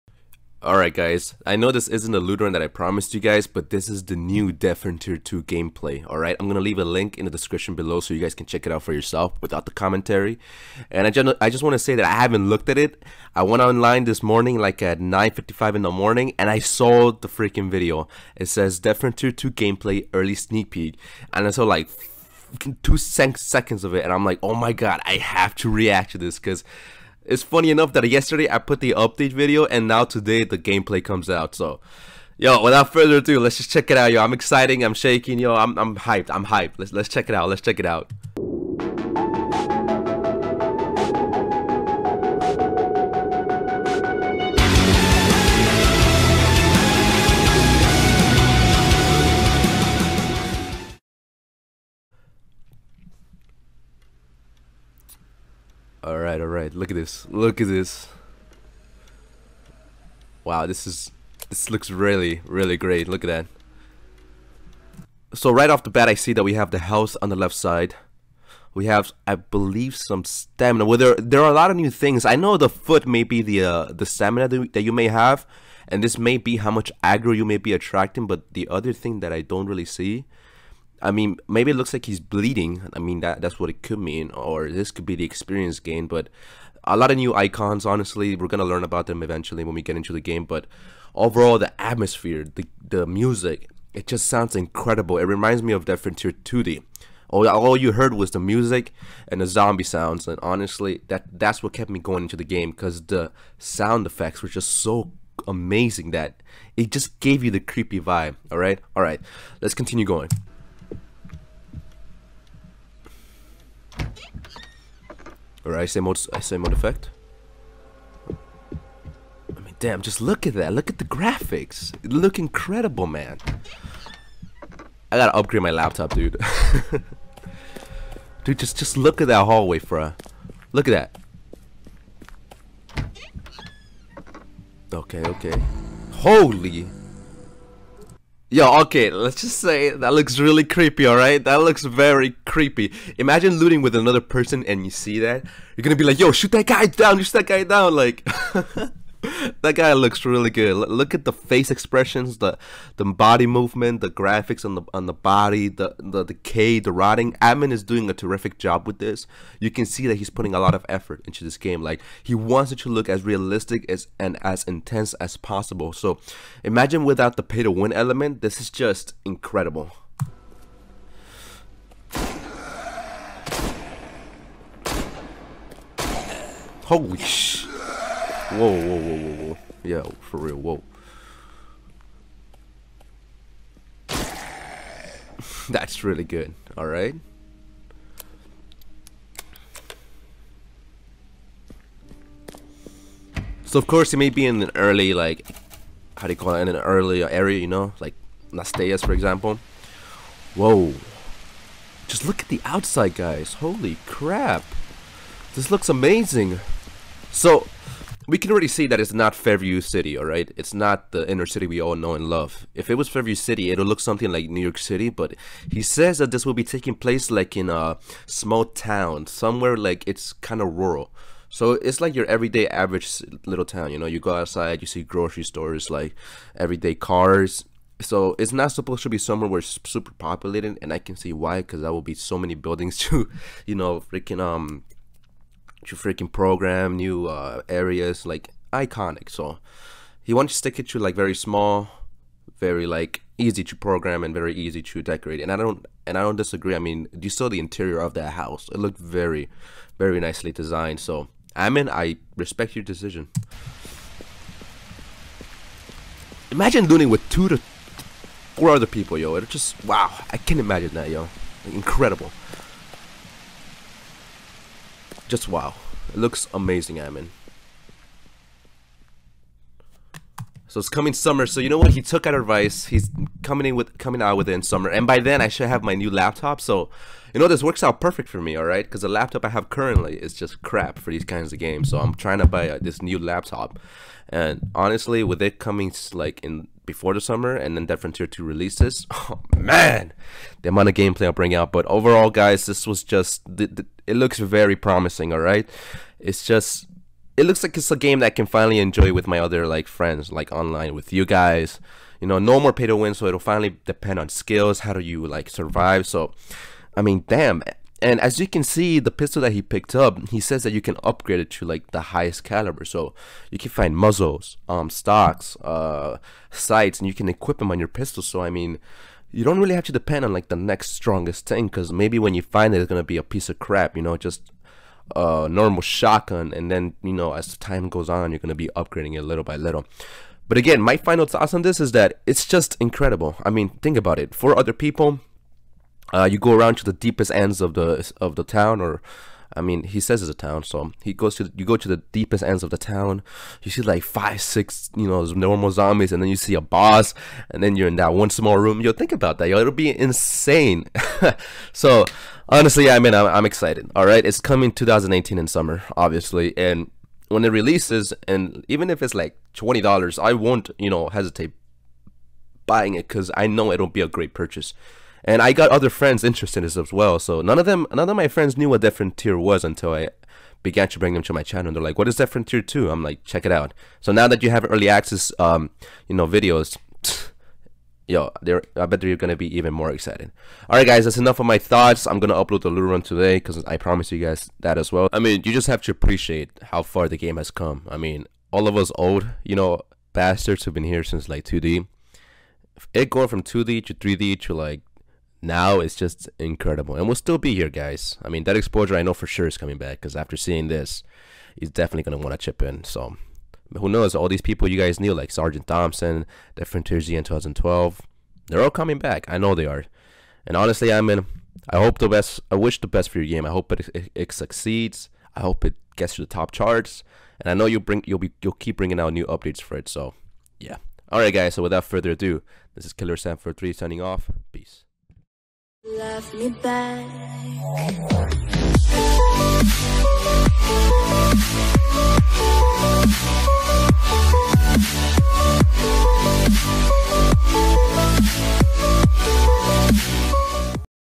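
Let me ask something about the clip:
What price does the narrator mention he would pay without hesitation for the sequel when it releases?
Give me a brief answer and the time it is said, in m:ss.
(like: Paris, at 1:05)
$20, at 5:59.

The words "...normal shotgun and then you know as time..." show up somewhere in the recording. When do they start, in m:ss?
5:25.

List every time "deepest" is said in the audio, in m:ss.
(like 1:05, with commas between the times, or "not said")
5:36, 5:42.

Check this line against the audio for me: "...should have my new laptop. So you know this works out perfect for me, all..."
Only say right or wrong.
right.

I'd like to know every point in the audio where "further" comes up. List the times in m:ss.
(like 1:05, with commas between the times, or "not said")
0:32, 7:01.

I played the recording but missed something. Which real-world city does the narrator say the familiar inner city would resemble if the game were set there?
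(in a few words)
New York City.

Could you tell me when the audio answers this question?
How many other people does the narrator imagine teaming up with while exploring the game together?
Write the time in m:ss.
4:17.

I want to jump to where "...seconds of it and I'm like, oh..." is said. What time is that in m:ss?
0:22.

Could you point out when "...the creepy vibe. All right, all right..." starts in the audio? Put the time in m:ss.
1:47.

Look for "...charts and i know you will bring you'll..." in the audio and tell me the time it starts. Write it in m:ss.
6:56.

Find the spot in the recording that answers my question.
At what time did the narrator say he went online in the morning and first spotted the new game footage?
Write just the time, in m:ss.
0:14.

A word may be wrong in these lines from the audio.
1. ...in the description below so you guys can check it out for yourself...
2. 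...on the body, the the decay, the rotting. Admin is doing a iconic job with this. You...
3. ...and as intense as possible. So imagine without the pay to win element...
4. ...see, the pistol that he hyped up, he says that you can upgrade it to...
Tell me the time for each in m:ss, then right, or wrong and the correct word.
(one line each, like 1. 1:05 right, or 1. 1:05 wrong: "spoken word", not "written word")
1. 0:07 right
2. 2:34 wrong: "terrific", not "iconic"
3. 2:44 right
4. 5:08 wrong: "picked", not "hyped".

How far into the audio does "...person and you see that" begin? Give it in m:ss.
2:24.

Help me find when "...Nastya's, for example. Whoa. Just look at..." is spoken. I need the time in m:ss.
3:18.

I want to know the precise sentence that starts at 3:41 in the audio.
So it's like your everyday average little town, you know, you go outside, you see grocery stores, like everyday cars.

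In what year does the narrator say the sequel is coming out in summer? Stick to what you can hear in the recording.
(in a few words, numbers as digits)
2018.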